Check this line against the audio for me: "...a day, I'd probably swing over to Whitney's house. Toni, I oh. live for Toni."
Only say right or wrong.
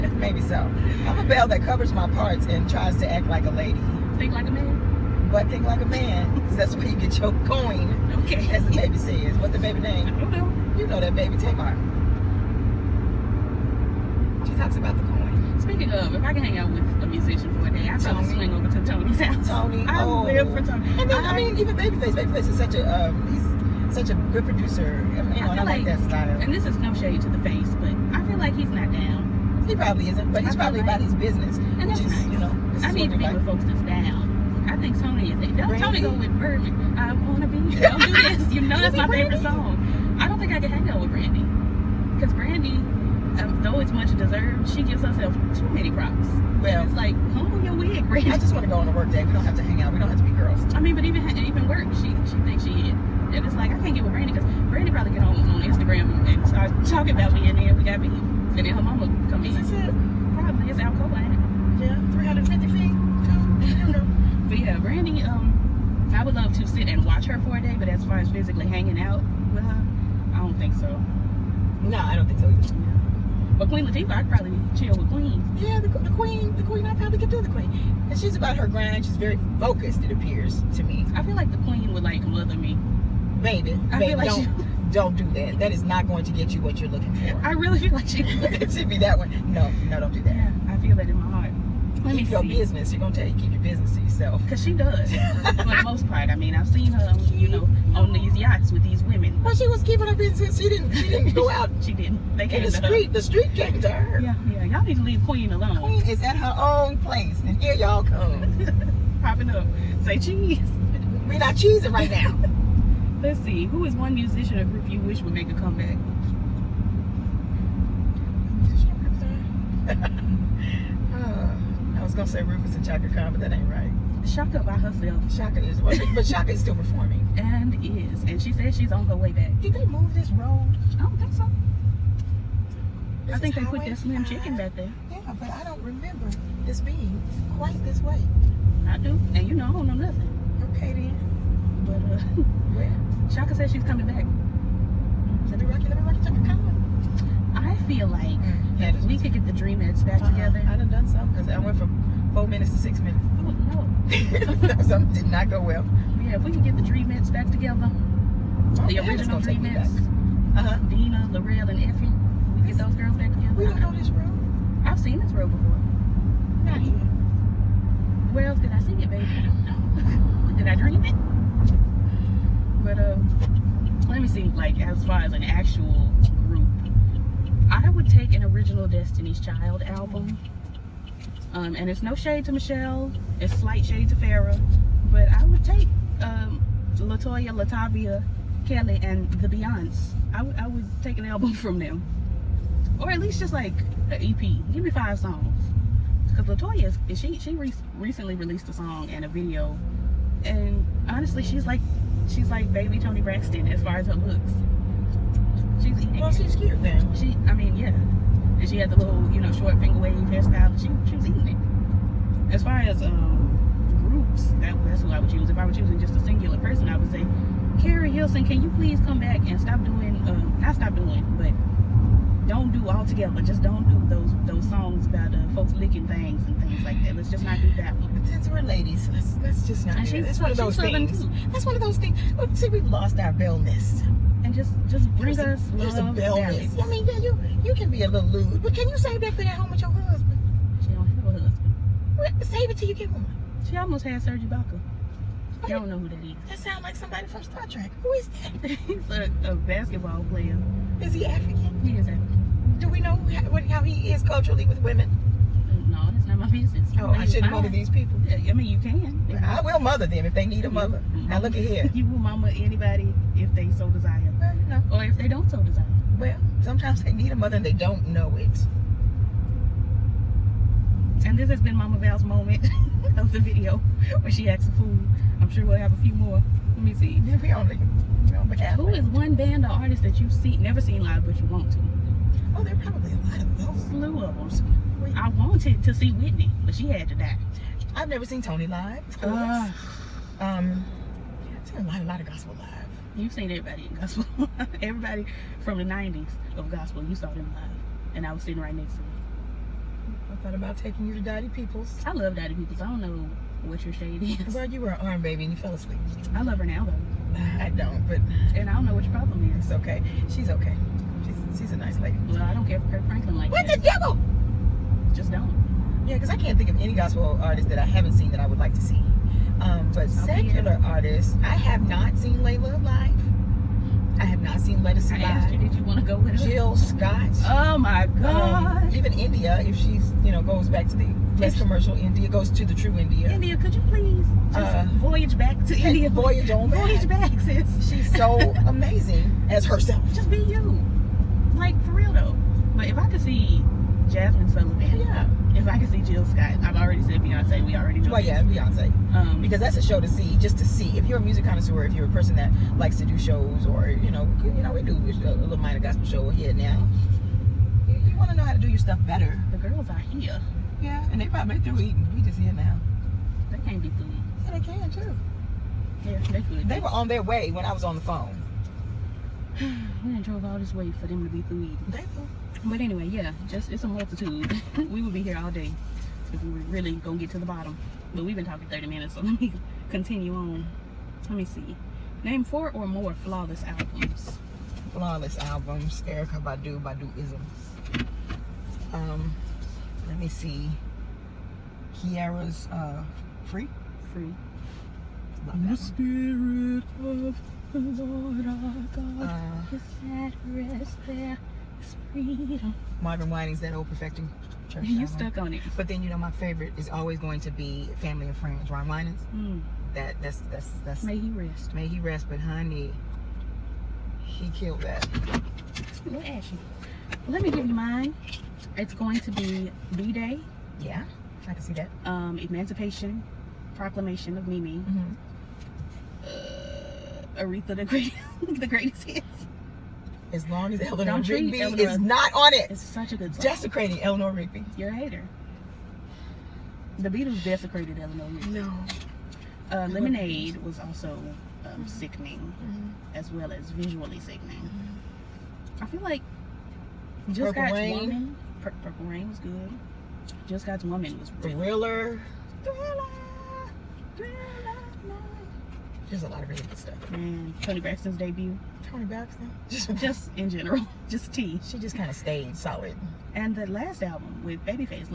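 wrong.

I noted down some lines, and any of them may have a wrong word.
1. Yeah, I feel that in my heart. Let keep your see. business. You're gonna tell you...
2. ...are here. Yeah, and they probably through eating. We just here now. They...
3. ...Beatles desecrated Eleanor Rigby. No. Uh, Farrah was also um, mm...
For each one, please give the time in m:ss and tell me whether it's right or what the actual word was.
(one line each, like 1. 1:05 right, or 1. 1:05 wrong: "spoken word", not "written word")
1. 1:30 right
2. 5:59 right
3. 7:17 wrong: "Lemonade", not "Farrah".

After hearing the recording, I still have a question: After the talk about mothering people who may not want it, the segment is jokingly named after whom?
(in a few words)
Mama Val.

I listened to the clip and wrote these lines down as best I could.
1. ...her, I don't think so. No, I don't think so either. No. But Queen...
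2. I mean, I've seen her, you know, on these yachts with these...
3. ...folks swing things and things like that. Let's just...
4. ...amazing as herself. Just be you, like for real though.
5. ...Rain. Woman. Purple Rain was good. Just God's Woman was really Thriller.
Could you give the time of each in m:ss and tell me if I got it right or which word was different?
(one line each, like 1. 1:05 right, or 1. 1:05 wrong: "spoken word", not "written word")
1. 1:09 right
2. 1:36 right
3. 3:45 wrong: "licking", not "swing"
4. 5:38 right
5. 7:27 right.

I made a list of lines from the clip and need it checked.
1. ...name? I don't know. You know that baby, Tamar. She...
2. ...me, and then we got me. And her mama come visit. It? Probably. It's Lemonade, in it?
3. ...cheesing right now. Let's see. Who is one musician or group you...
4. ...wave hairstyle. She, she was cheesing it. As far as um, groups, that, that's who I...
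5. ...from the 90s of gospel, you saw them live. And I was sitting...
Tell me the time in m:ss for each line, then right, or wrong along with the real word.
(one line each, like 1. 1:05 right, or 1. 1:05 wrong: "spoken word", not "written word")
1. 0:09 right
2. 0:57 wrong: "Alcoa", not "Lemonade"
3. 1:51 right
4. 3:29 wrong: "eating", not "cheesing"
5. 4:55 right.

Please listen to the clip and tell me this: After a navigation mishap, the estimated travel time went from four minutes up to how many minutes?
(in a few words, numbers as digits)
6 minutes.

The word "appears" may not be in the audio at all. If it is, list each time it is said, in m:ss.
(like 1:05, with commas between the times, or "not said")
1:20.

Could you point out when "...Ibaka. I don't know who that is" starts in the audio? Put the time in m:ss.
4:04.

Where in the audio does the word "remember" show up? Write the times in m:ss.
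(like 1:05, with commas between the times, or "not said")
2:15.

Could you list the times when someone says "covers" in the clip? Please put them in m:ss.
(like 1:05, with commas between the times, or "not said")
0:01.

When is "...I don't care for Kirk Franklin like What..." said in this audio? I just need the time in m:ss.
5:12.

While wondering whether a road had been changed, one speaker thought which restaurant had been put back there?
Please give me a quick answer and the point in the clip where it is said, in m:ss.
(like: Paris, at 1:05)
Slim Chicken, at 2:13.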